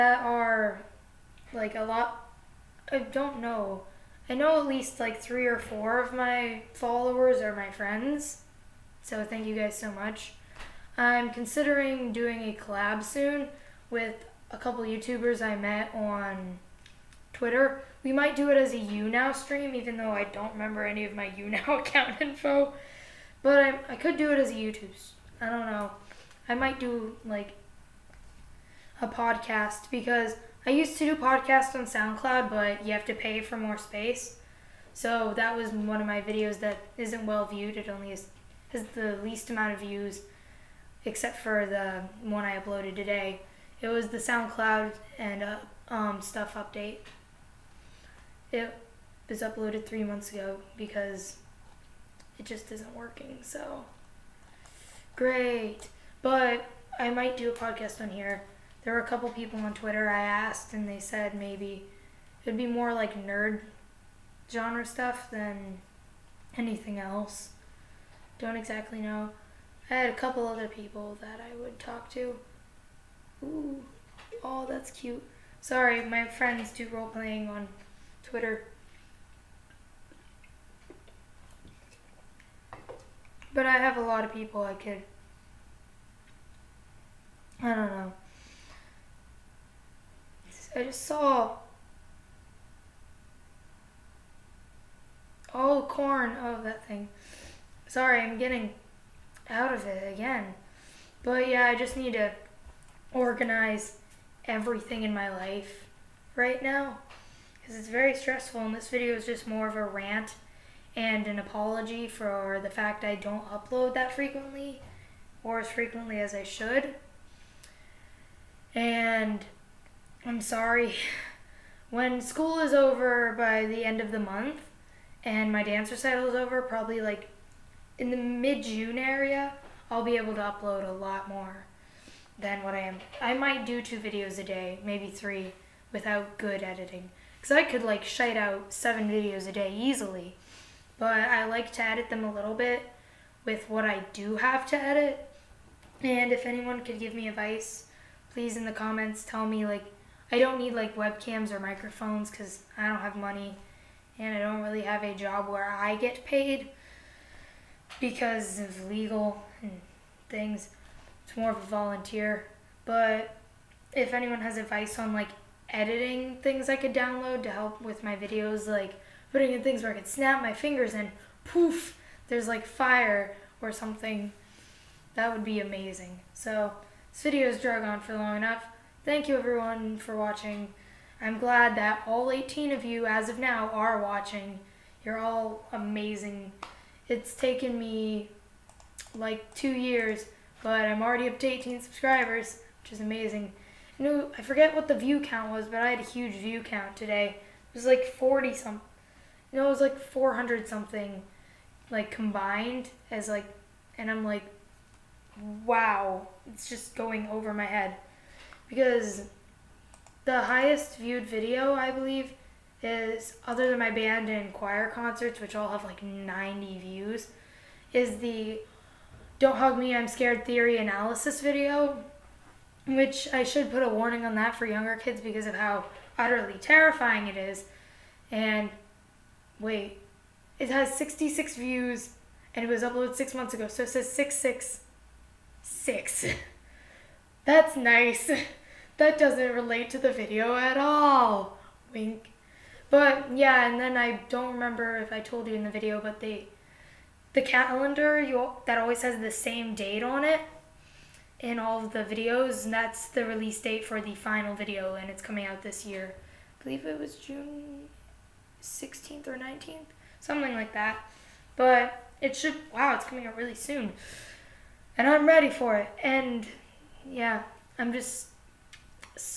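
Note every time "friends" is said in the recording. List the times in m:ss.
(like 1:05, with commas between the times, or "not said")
0:07, 1:16.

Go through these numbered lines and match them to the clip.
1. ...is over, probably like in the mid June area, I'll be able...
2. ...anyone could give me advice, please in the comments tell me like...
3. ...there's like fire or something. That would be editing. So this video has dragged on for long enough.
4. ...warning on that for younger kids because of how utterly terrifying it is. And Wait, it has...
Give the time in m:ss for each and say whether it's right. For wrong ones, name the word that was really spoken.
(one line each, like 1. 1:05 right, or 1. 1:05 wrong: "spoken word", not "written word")
1. 2:06 right
2. 2:26 right
3. 2:52 wrong: "amazing", not "editing"
4. 3:43 right.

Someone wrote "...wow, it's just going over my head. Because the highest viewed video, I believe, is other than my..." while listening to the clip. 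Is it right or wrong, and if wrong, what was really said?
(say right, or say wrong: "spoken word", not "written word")
right.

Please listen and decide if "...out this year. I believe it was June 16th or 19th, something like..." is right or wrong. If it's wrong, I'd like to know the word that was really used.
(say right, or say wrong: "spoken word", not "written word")
right.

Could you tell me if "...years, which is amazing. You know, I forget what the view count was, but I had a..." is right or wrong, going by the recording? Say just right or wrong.
wrong.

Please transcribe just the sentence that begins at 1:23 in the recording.
But I have a lot of people I could.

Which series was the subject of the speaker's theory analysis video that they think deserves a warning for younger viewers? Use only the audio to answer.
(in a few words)
Don't Hug Me, I'm Scared.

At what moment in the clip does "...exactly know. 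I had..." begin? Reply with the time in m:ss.
1:08.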